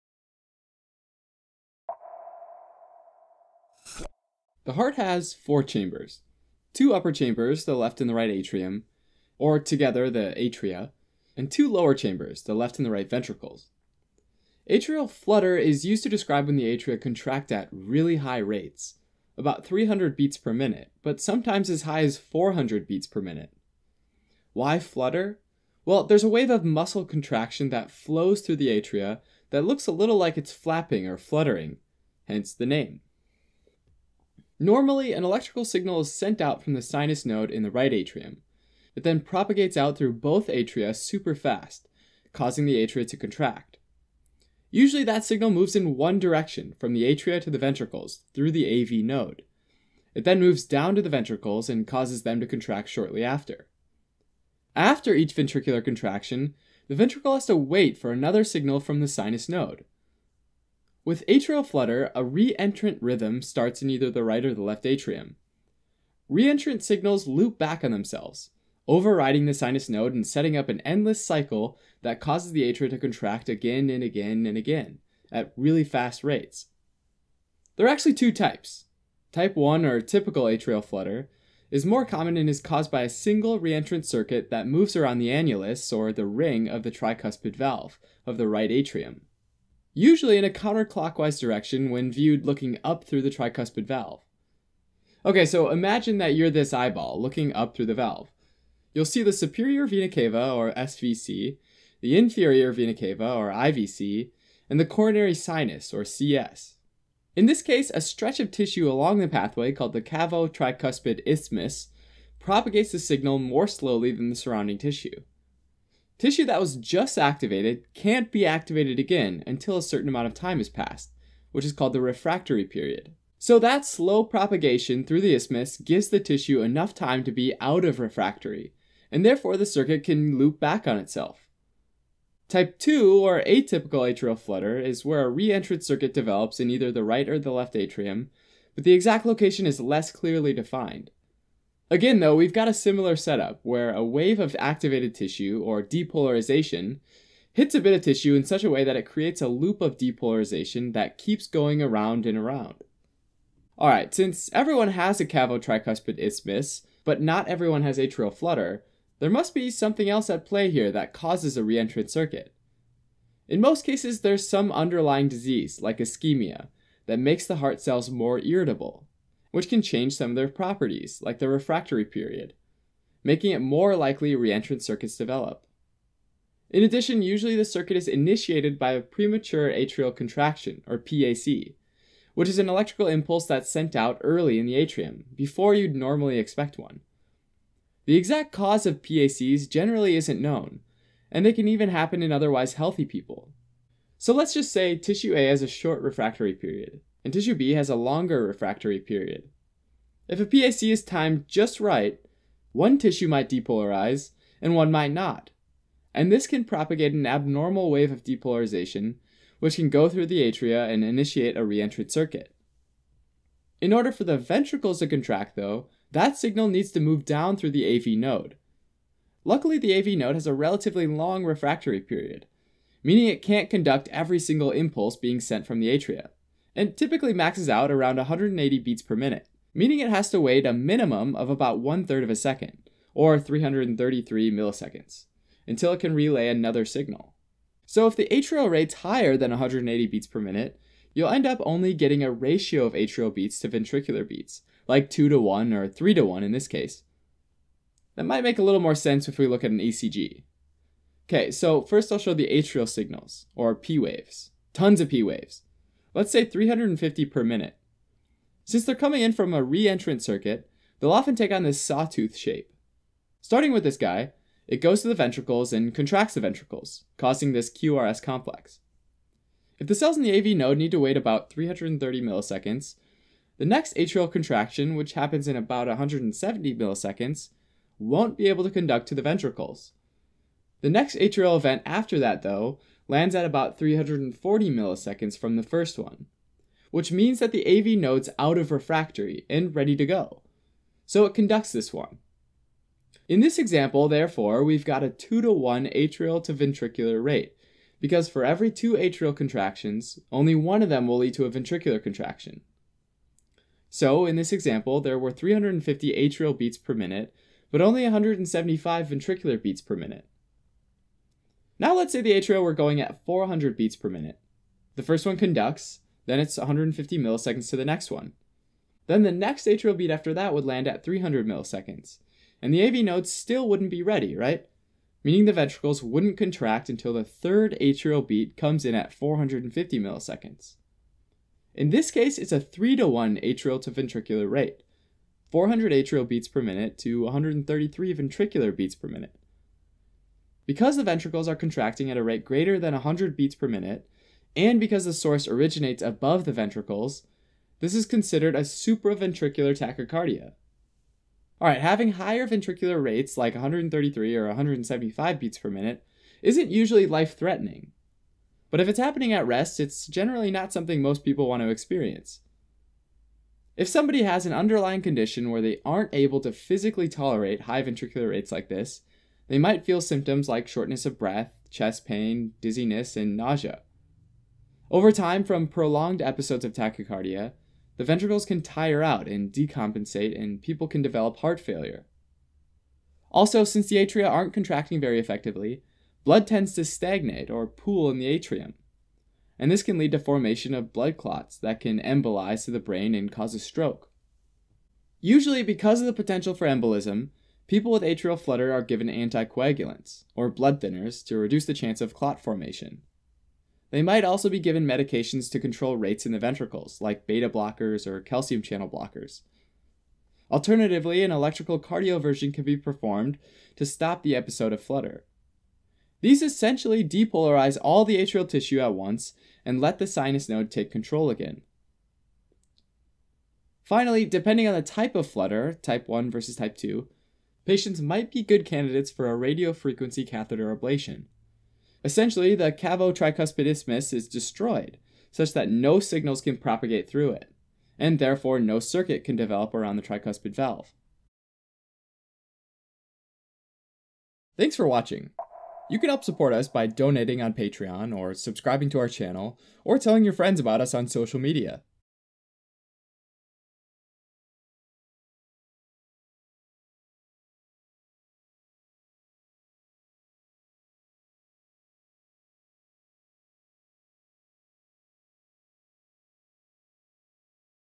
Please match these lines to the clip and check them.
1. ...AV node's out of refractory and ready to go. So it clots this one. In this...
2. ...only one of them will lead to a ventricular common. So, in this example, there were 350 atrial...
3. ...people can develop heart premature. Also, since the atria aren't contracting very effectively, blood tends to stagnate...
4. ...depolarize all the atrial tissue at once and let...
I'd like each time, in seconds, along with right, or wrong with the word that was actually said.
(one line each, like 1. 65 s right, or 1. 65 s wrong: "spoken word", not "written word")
1. 287 s wrong: "conducts", not "clots"
2. 300 s wrong: "contraction", not "common"
3. 380 s wrong: "failure", not "premature"
4. 417 s right.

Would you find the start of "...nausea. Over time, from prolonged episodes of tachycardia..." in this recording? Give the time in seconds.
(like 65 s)
373 s.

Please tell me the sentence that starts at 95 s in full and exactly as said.
Okay, so imagine that you're this eyeball looking up through the valve.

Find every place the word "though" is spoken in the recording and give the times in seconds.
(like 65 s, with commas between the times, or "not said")
142 s, 215 s, 282 s.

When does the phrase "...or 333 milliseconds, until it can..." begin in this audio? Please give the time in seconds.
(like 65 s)
233 s.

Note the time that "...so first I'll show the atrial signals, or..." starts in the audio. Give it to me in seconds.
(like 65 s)
251 s.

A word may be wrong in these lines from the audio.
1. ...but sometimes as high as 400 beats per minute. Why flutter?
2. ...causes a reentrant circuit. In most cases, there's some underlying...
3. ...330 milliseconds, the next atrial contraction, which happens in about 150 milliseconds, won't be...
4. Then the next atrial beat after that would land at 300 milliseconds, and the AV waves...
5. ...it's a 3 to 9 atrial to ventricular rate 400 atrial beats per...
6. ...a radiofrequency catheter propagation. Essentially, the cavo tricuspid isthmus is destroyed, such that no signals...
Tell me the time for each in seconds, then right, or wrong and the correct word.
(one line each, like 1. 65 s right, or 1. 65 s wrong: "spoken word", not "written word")
1. 21 s right
2. 161 s right
3. 271 s wrong: "170", not "150"
4. 319 s wrong: "nodes", not "waves"
5. 332 s wrong: "1", not "9"
6. 429 s wrong: "ablation", not "propagation".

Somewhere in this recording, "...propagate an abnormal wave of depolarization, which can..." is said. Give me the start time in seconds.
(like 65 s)
206 s.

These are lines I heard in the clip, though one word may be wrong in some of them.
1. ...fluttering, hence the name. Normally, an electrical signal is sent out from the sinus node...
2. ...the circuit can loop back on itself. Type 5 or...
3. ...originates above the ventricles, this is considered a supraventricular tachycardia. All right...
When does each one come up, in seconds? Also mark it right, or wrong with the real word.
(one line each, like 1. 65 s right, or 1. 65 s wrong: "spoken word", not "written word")
1. 31 s right
2. 129 s wrong: "2", not "5"
3. 345 s right.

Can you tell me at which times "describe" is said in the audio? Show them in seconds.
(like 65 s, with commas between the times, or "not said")
16 s.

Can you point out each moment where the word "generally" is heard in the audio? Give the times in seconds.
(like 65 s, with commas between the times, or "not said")
189 s, 360 s.